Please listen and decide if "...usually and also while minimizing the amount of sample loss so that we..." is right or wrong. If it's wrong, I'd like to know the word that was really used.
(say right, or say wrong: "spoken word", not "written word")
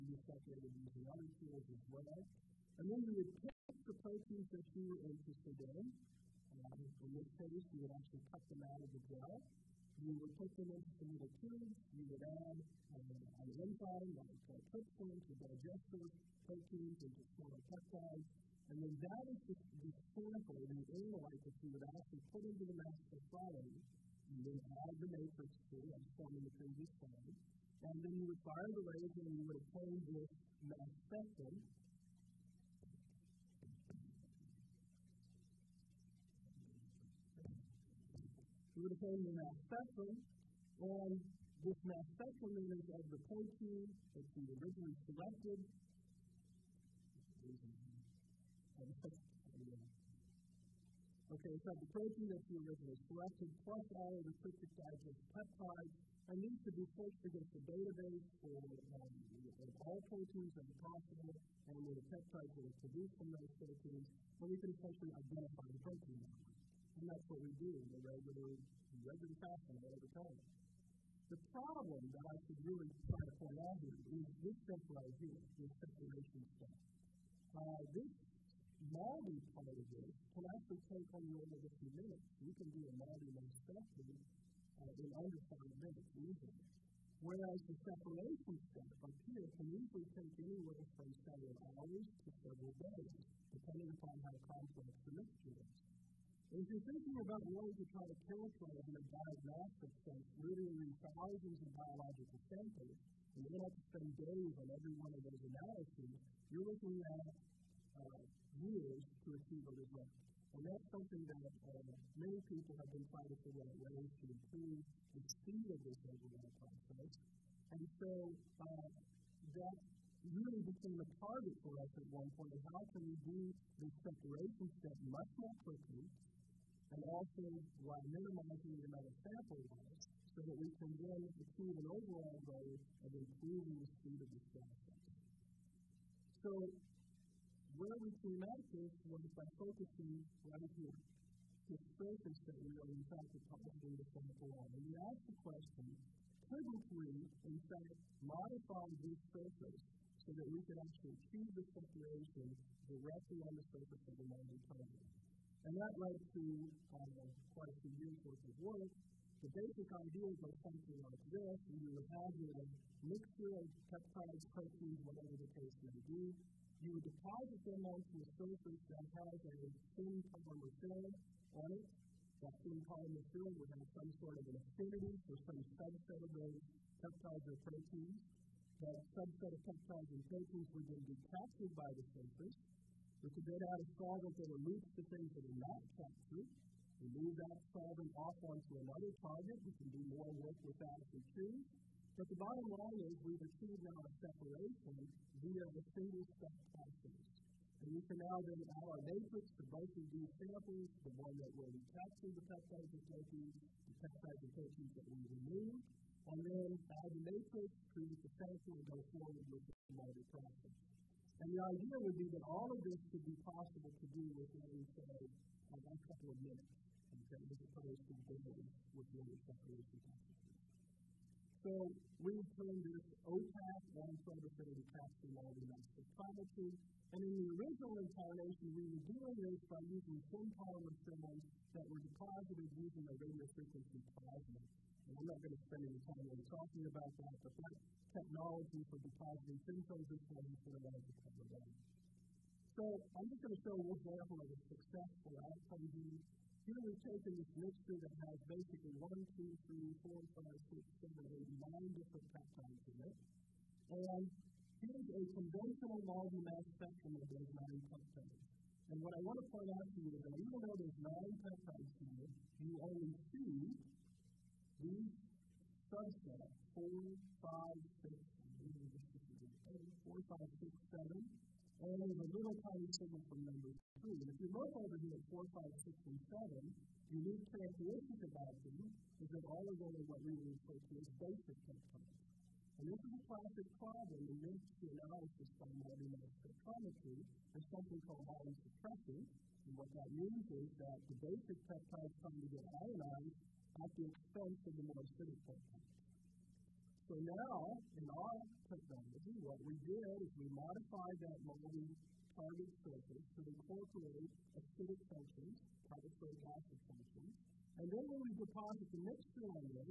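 wrong: "quickly", not "usually".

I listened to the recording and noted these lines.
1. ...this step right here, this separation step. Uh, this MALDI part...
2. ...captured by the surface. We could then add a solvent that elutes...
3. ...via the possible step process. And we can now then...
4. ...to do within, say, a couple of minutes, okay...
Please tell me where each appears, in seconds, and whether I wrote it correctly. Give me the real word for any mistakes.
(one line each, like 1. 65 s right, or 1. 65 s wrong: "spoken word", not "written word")
1. 74 s right
2. 181 s right
3. 195 s wrong: "single", not "possible"
4. 213 s right.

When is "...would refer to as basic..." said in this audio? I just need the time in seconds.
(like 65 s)
280 s.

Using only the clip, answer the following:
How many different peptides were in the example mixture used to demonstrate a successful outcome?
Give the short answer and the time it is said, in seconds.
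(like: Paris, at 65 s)
9, at 251 s.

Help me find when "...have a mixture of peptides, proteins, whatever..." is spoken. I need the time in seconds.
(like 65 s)
162 s.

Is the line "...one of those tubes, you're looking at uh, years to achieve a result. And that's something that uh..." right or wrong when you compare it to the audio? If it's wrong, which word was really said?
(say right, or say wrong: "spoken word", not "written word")
wrong: "analyses", not "tubes".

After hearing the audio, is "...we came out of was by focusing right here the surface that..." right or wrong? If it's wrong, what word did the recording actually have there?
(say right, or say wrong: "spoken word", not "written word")
right.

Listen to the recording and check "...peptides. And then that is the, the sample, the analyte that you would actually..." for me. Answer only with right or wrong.
right.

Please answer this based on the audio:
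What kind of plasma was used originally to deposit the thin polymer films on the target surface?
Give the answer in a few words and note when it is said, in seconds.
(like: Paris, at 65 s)
radio frequency plasma, at 233 s.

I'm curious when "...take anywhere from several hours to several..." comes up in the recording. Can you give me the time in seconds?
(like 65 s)
90 s.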